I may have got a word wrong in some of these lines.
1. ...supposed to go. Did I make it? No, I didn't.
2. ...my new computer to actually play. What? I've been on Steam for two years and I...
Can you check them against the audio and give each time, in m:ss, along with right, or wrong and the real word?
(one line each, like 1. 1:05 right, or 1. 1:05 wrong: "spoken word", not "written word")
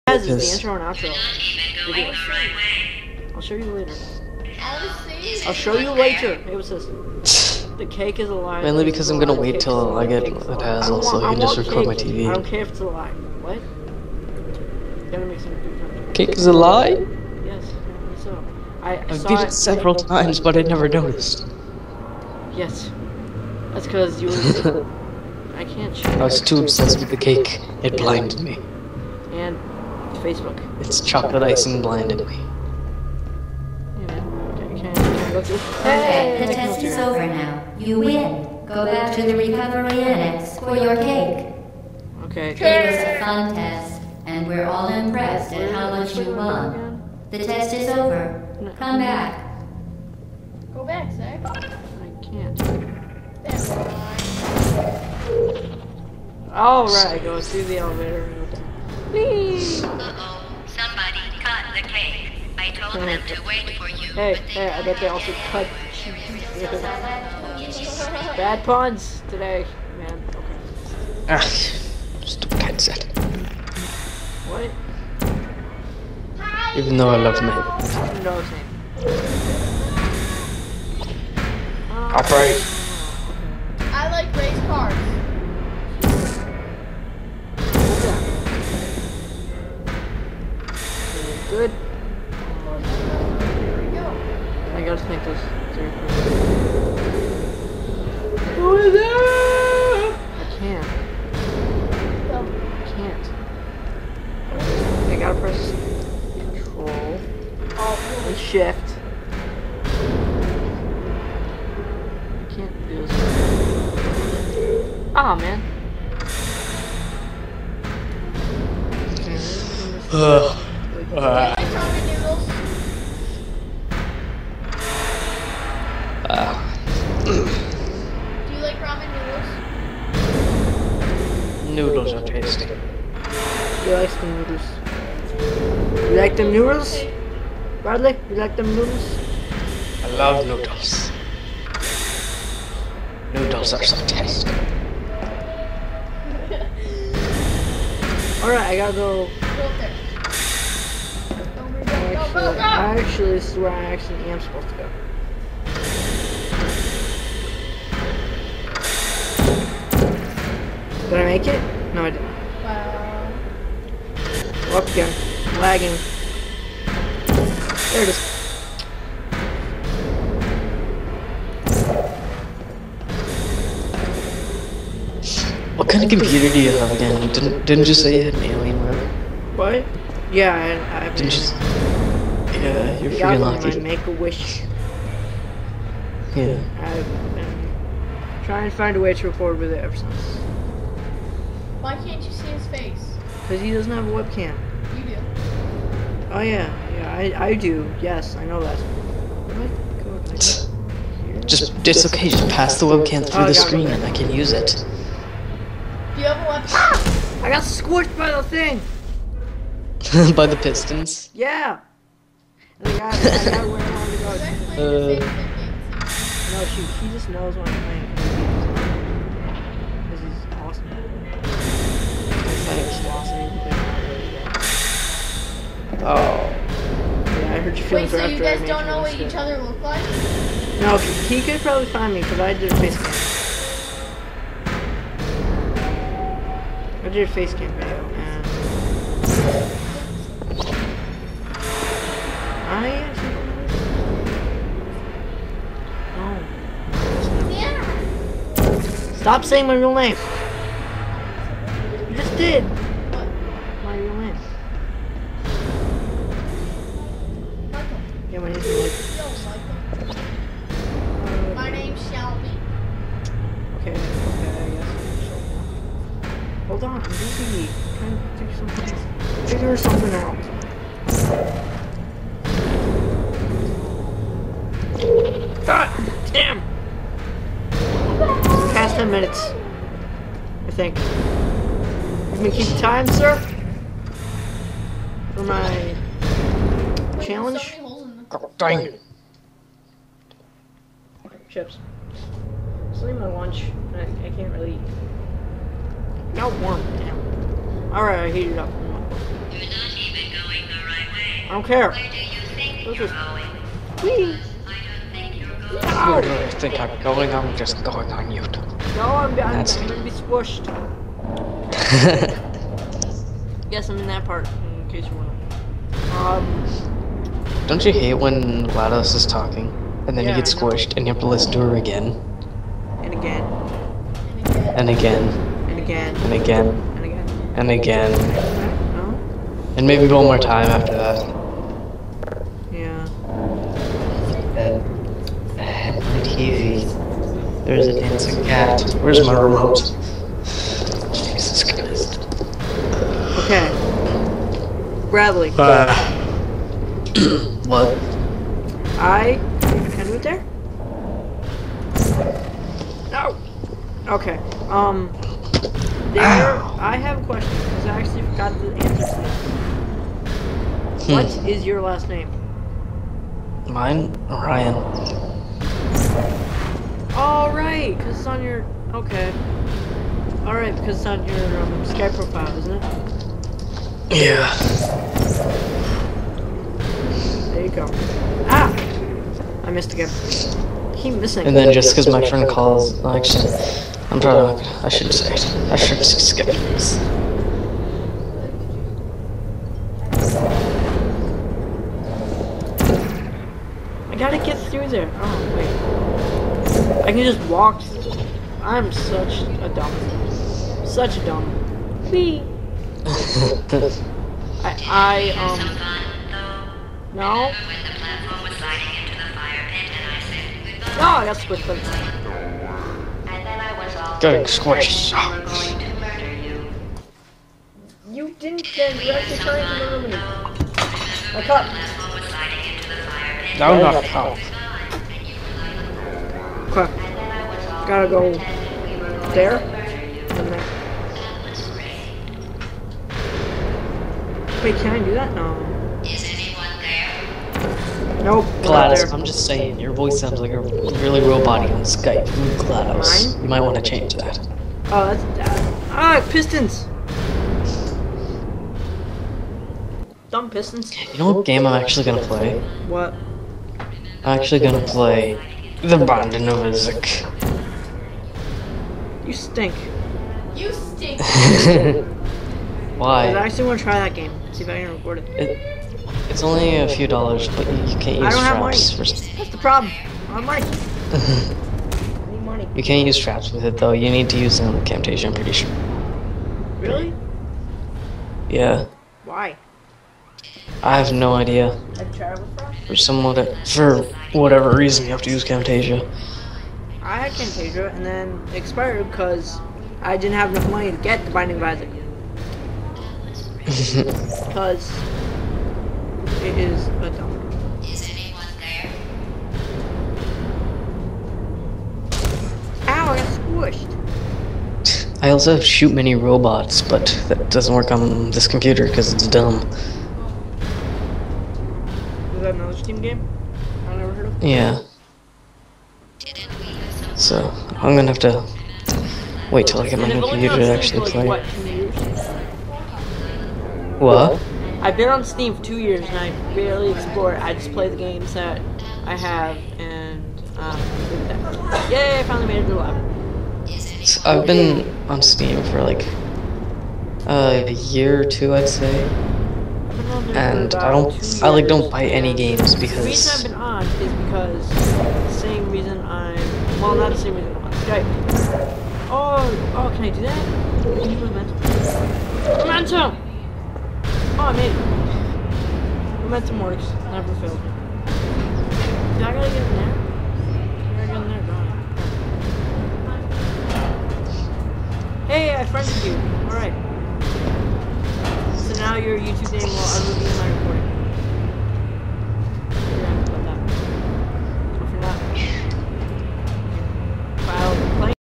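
1. 2:34 right
2. 8:39 right.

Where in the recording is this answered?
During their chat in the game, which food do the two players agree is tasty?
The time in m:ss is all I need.
2:08.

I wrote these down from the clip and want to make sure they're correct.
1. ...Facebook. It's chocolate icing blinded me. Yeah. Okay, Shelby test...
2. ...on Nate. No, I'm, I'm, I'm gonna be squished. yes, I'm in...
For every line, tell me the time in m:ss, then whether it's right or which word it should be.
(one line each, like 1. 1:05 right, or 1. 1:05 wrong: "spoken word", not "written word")
1. 0:30 wrong: "The", not "Shelby"
2. 5:08 wrong: "YouTube", not "Nate".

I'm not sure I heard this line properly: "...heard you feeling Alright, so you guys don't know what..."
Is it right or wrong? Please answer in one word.
wrong.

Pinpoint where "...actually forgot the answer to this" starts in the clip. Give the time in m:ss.
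5:57.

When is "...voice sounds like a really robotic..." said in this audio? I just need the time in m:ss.
7:19.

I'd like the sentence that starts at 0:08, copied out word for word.
Mainly because I'm gonna wait till I get the dazzle so I can just record my TV.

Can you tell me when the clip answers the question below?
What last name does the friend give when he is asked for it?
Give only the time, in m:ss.
6:04.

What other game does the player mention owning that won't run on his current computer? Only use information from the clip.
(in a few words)
Shoot Many Robots.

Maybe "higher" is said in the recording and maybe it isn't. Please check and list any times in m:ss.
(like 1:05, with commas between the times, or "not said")
not said.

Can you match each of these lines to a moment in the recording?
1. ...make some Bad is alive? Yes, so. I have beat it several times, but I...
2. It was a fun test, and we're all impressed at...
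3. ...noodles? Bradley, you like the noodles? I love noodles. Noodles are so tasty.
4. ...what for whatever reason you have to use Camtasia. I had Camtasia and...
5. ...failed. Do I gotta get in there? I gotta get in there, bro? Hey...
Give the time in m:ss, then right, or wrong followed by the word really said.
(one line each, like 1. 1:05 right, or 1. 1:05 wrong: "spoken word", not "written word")
1. 0:15 wrong: "Cake", not "Bad"
2. 0:42 right
3. 2:16 right
4. 8:03 right
5. 9:17 right.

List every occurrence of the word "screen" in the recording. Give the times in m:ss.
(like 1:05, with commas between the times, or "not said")
3:23.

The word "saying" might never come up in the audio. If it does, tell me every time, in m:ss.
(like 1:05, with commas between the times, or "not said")
4:09, 7:19.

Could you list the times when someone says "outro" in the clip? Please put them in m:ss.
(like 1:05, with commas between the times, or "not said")
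0:00.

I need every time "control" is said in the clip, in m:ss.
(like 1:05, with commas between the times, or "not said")
1:46.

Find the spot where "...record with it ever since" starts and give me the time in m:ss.
3:09.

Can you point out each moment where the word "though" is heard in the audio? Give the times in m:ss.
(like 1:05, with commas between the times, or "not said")
1:16, 7:53.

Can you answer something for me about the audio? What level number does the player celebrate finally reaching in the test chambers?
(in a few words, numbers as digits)
11.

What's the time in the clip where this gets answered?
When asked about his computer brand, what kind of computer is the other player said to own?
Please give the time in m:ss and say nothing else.
2:58.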